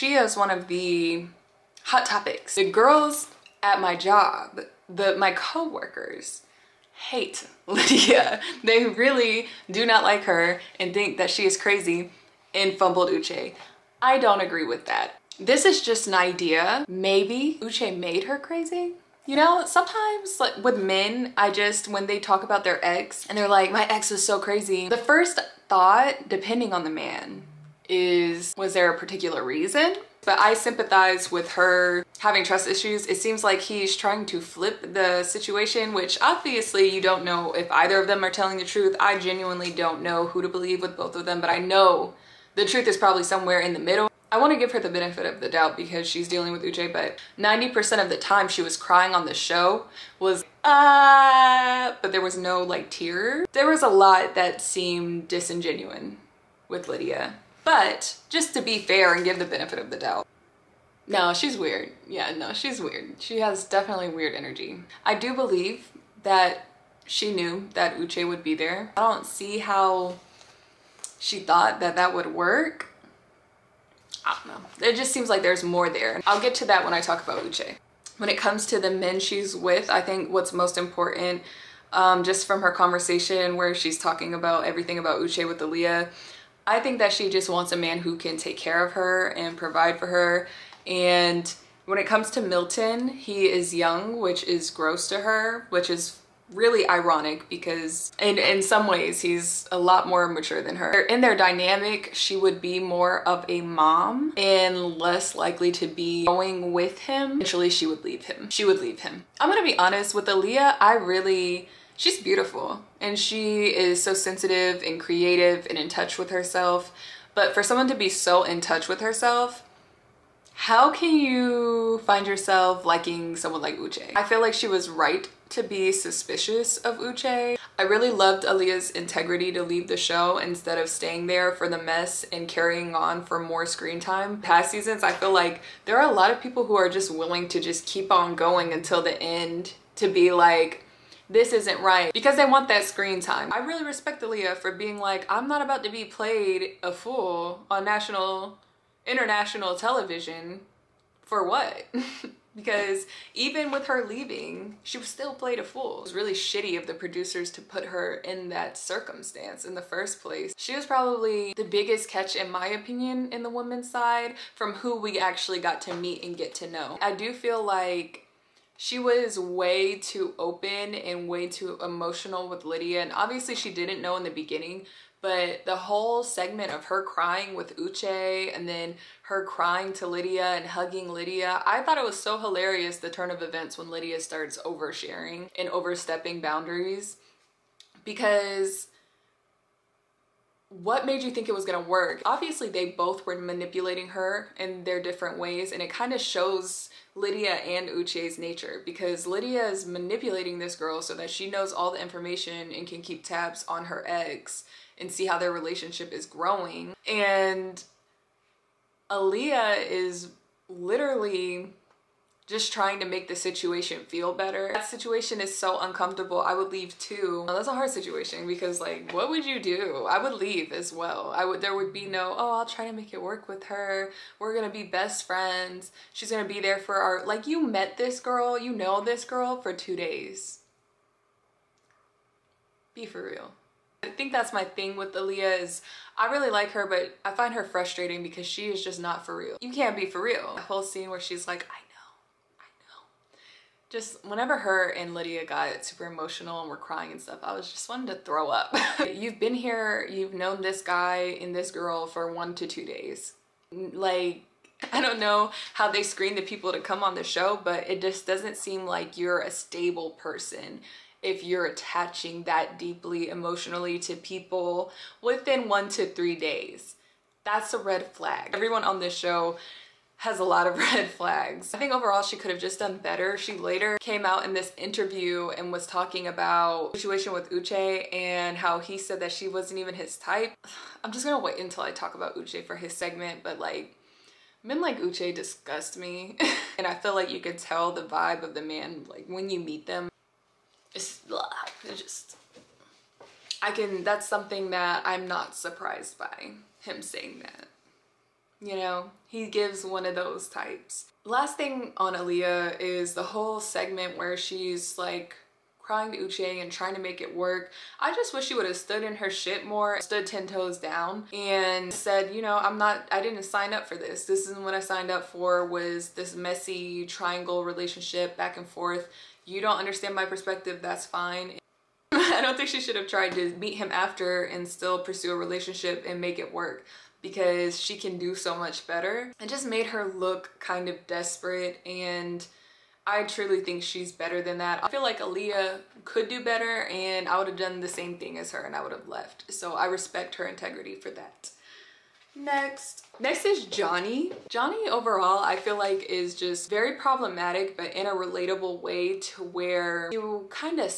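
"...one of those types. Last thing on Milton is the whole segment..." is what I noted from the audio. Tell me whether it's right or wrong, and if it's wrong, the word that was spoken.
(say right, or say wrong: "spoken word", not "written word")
wrong: "Aaliyah", not "Milton".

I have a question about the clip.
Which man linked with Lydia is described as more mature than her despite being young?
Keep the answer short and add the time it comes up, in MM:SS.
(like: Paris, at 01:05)
Milton, at 01:32.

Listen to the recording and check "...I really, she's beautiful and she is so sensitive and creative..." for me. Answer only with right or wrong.
right.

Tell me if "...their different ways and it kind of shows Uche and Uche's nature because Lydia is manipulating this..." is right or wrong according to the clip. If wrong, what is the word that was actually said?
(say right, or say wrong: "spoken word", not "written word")
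wrong: "Lydia", not "Uche".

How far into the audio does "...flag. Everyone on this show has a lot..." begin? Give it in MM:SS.
04:28.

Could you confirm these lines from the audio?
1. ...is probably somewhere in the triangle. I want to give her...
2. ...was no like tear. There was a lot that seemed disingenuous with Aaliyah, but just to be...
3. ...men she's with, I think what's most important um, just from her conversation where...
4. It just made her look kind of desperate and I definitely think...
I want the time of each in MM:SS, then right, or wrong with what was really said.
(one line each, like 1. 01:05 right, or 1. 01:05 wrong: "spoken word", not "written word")
1. 00:42 wrong: "middle", not "triangle"
2. 00:52 wrong: "Lydia", not "Aaliyah"
3. 01:18 right
4. 05:29 wrong: "truly", not "definitely".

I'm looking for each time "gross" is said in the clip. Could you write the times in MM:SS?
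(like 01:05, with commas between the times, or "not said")
01:34.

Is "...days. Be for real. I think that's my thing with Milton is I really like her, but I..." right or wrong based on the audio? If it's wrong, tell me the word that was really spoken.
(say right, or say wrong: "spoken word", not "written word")
wrong: "Aaliyah", not "Milton".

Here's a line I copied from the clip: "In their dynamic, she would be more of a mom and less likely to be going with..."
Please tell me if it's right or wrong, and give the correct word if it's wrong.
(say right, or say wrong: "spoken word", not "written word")
right.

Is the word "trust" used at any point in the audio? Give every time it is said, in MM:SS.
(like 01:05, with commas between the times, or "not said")
00:32.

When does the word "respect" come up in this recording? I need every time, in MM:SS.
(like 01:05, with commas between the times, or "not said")
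02:23, 05:39.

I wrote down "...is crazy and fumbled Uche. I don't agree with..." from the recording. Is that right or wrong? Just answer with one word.
right.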